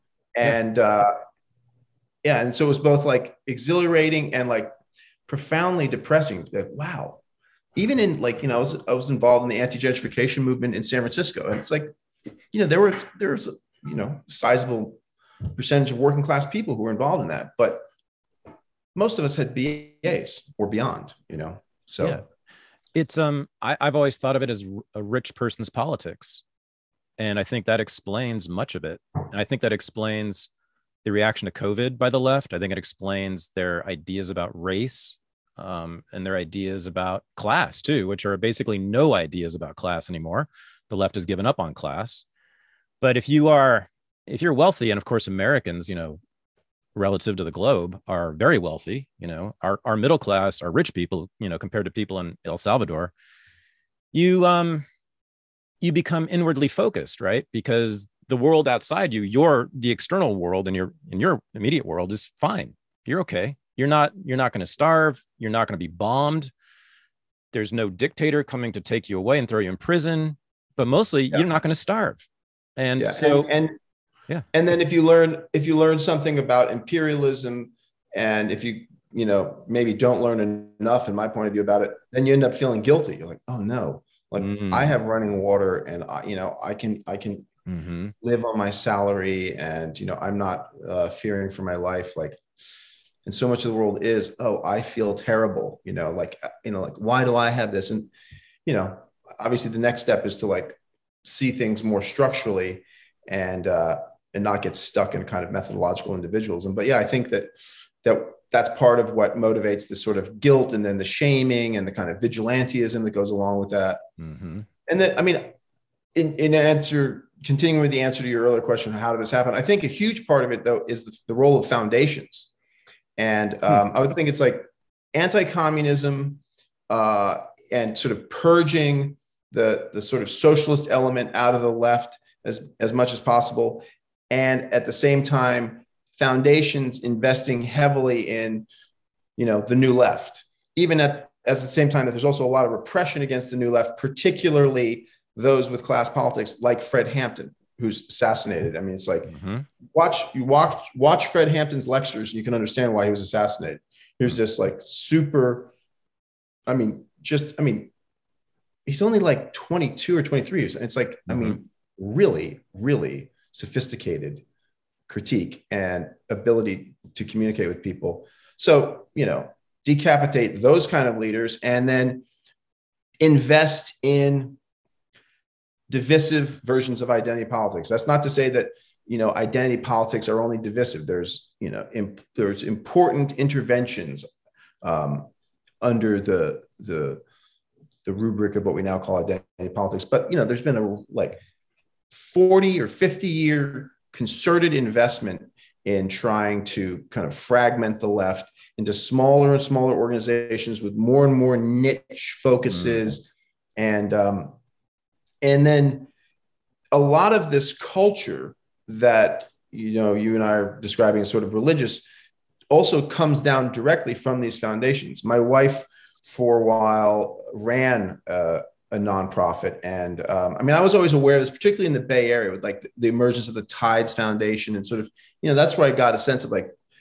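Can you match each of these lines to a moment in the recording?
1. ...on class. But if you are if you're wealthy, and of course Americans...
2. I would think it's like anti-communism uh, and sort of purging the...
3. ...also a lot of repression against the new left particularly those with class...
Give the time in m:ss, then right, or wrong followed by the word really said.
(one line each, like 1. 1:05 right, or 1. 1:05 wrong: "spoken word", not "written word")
1. 0:41 right
2. 2:03 right
3. 2:22 right.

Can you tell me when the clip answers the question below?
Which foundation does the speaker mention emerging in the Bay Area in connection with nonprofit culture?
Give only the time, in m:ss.
3:43.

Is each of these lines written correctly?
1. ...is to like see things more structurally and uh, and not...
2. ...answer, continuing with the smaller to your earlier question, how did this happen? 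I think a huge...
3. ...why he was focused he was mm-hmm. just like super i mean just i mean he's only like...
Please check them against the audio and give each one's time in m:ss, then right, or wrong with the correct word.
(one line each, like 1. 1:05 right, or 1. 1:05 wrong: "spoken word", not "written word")
1. 1:40 right
2. 1:56 wrong: "answer", not "smaller"
3. 2:32 wrong: "assassinated", not "focused".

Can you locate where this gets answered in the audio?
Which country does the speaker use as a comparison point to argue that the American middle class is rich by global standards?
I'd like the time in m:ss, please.
0:52.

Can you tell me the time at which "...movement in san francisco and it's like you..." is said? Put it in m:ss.
0:10.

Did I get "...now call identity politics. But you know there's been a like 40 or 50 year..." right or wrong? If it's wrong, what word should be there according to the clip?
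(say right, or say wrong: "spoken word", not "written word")
right.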